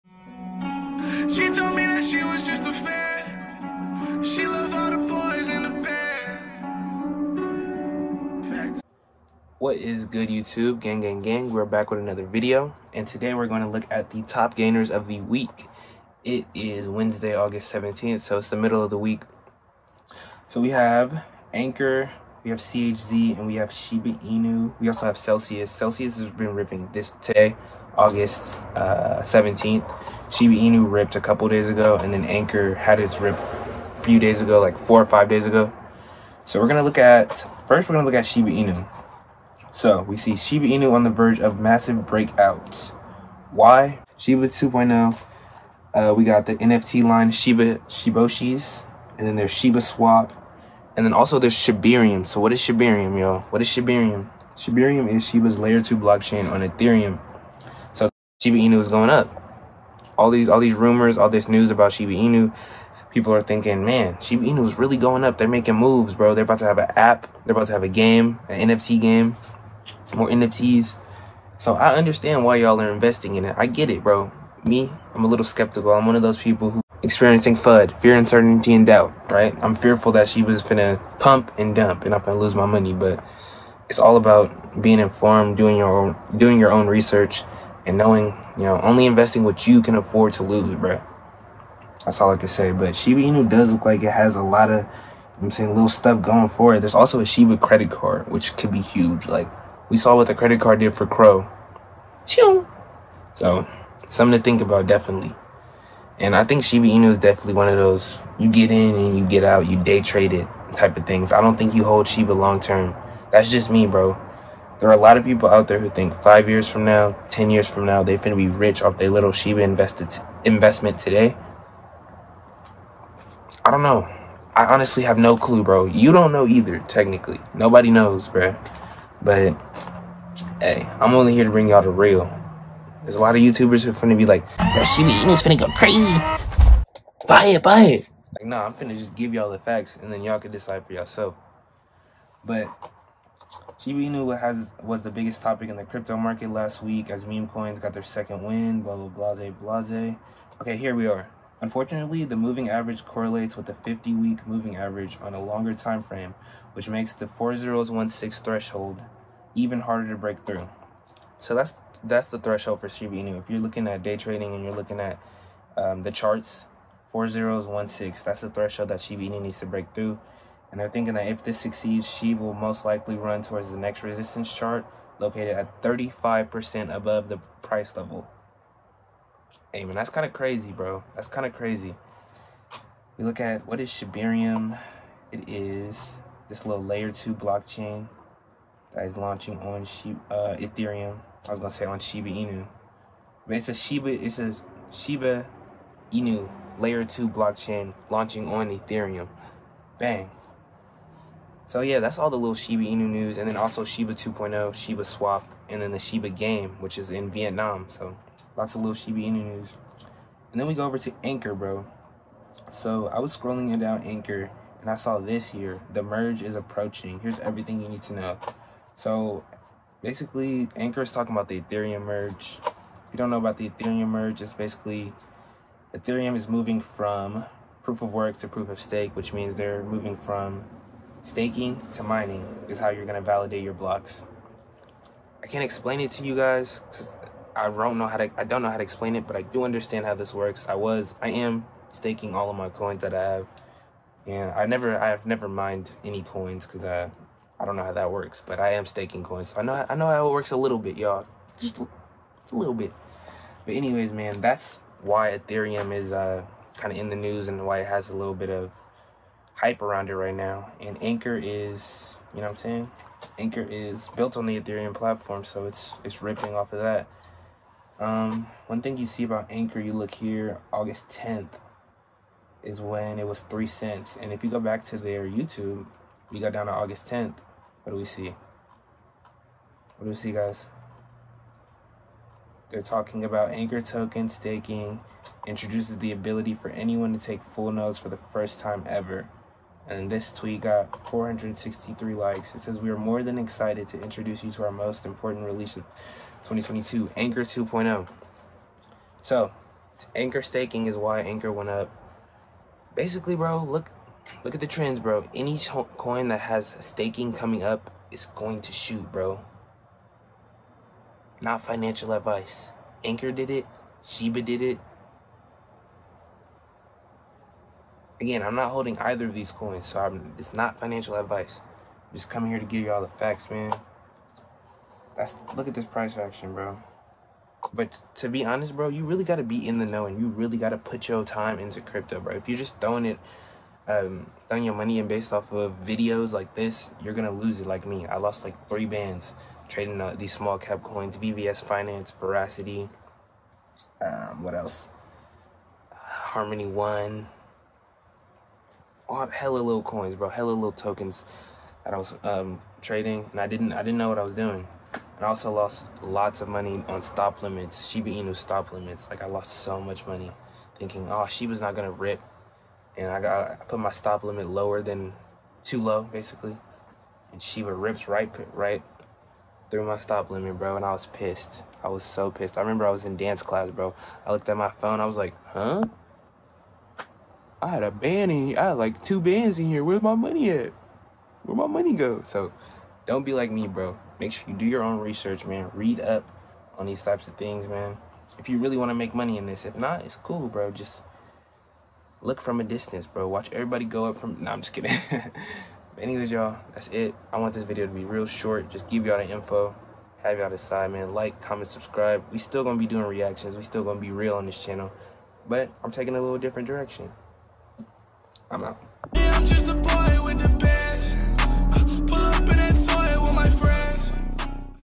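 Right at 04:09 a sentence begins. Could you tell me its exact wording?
So I know I know how it works a little bit, y'all.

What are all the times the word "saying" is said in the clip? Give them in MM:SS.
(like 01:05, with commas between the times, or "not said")
01:35, 04:22.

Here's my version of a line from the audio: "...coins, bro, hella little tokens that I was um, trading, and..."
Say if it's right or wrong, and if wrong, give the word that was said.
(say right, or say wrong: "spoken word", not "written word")
right.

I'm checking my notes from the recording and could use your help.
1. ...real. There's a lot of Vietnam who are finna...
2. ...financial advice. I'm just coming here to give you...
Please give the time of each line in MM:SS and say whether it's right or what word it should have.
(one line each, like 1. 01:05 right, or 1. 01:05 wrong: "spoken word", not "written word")
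1. 02:11 wrong: "YouTubers", not "Vietnam"
2. 05:20 right.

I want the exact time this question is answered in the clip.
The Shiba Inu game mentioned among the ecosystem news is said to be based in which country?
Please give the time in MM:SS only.
03:27.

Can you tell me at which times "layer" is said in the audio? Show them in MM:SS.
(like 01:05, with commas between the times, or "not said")
00:55, 03:06, 03:16.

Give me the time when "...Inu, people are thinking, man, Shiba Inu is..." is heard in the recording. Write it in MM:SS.
01:02.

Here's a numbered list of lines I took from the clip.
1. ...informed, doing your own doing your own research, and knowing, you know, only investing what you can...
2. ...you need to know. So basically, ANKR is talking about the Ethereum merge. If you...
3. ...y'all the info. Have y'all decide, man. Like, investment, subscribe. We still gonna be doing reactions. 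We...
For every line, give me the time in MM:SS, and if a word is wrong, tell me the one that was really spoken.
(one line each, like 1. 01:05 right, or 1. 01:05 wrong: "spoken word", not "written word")
1. 01:24 right
2. 03:37 right
3. 06:39 wrong: "comment", not "investment".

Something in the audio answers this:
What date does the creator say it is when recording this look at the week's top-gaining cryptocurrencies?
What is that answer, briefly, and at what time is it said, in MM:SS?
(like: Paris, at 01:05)
August 17th, at 00:17.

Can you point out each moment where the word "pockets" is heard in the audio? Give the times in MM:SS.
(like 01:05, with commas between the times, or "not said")
not said.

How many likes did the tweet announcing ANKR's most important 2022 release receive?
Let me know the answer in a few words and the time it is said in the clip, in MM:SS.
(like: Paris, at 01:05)
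463, at 04:51.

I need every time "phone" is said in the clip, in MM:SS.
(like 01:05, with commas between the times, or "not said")
06:14.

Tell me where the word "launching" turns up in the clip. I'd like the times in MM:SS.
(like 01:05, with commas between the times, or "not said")
03:09, 03:18.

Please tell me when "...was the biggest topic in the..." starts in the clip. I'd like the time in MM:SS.
02:24.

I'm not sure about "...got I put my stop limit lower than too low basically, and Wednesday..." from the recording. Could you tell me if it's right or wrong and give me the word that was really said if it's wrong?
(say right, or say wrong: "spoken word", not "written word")
wrong: "Shiba", not "Wednesday".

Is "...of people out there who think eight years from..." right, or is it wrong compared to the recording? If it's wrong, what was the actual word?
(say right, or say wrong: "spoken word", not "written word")
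wrong: "five", not "eight".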